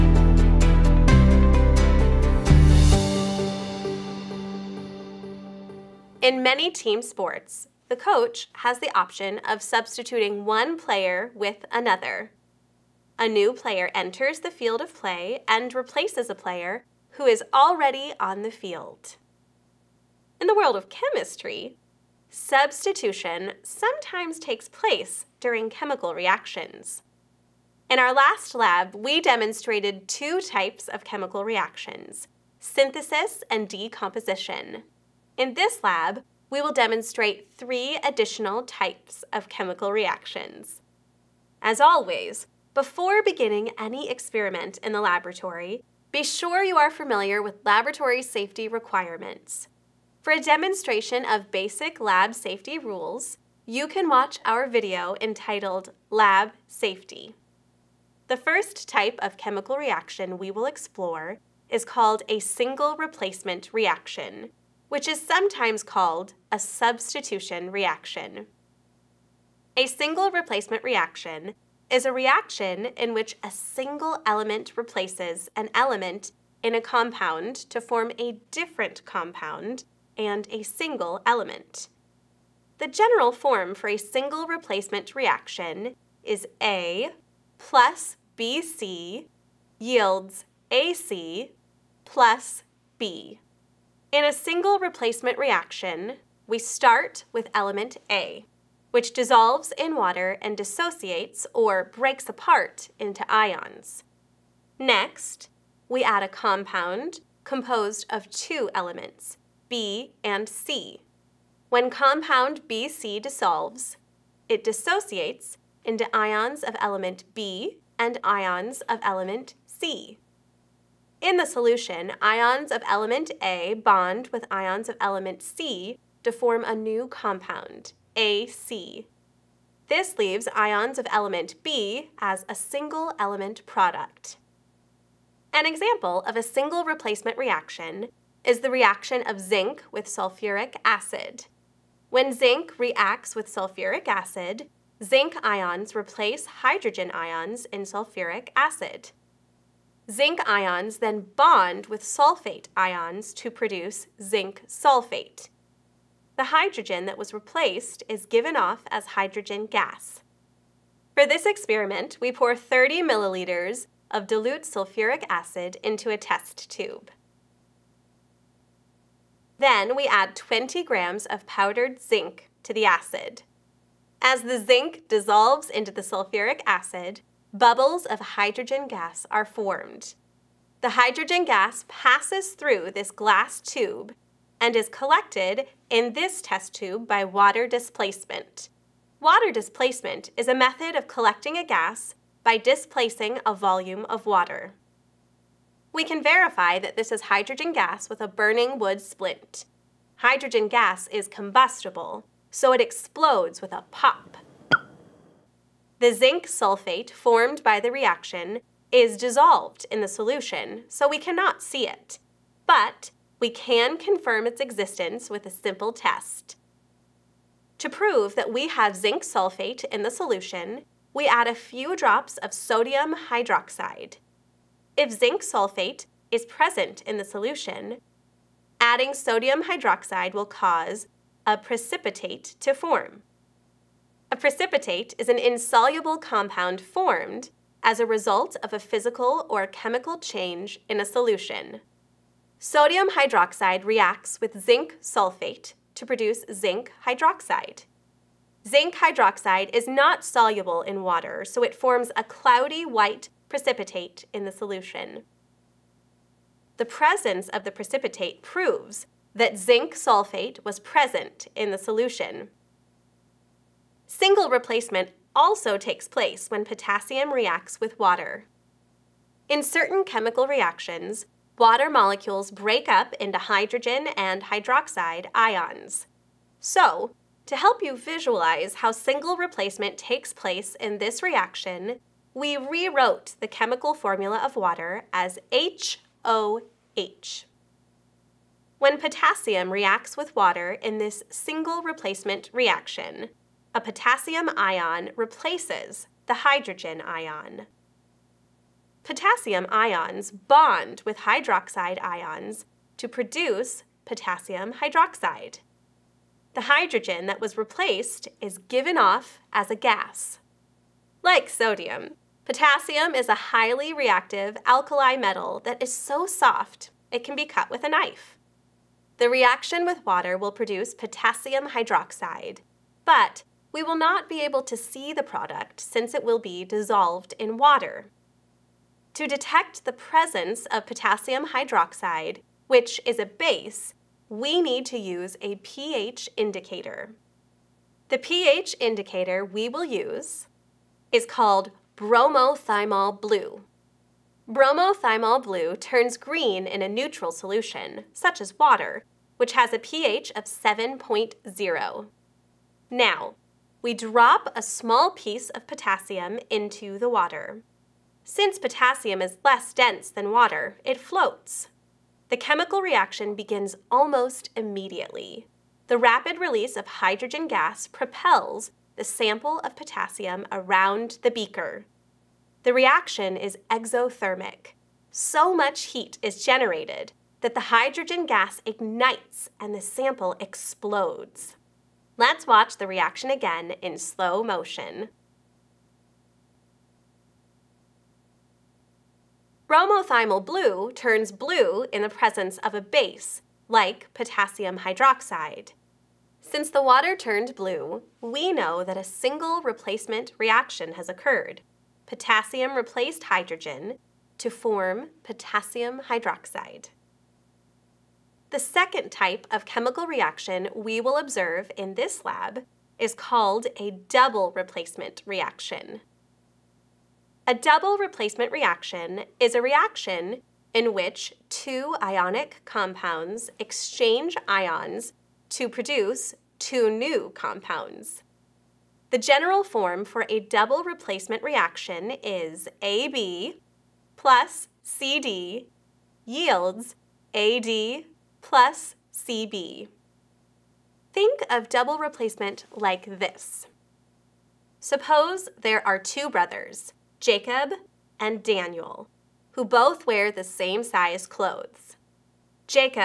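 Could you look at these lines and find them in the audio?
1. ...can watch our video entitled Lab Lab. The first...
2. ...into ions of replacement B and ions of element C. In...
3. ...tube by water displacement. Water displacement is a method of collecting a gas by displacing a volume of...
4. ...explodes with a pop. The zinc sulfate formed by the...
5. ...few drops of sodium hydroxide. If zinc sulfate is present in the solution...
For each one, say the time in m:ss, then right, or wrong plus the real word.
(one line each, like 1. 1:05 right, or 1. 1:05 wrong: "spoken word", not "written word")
1. 0:53 wrong: "Safety", not "Lab"
2. 1:55 wrong: "element", not "replacement"
3. 3:06 right
4. 3:22 right
5. 3:41 right.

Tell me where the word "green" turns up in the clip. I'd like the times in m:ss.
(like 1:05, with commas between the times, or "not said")
5:46.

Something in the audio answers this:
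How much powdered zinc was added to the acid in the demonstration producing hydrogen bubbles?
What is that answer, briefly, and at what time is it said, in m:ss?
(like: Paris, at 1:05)
20 grams, at 2:50.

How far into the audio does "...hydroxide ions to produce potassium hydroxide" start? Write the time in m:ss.
5:01.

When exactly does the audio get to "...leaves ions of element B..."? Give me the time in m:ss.
2:10.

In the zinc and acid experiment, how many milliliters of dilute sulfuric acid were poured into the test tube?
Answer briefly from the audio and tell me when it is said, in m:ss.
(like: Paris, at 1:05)
30 milliliters, at 2:42.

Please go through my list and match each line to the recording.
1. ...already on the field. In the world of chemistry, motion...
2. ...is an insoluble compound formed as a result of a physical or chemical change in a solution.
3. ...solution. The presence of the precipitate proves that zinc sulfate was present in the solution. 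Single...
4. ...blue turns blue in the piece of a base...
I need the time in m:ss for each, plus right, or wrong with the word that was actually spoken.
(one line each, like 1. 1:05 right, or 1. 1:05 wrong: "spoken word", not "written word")
1. 0:17 wrong: "substitution", not "motion"
2. 3:55 right
3. 4:14 right
4. 6:30 wrong: "presence", not "piece".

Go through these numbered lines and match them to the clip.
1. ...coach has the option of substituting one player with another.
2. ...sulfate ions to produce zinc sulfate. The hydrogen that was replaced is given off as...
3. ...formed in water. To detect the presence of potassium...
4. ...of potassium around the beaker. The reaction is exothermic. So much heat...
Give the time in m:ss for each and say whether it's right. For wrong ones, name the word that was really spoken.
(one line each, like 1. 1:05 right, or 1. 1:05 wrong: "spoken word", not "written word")
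1. 0:07 right
2. 2:32 right
3. 5:26 wrong: "dissolved", not "formed"
4. 6:09 right.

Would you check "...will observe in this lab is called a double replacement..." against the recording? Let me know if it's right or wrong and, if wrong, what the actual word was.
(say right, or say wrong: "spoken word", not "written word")
right.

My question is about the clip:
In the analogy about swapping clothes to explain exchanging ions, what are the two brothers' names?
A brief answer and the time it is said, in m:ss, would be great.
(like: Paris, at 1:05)
Jacob and Daniel, at 7:27.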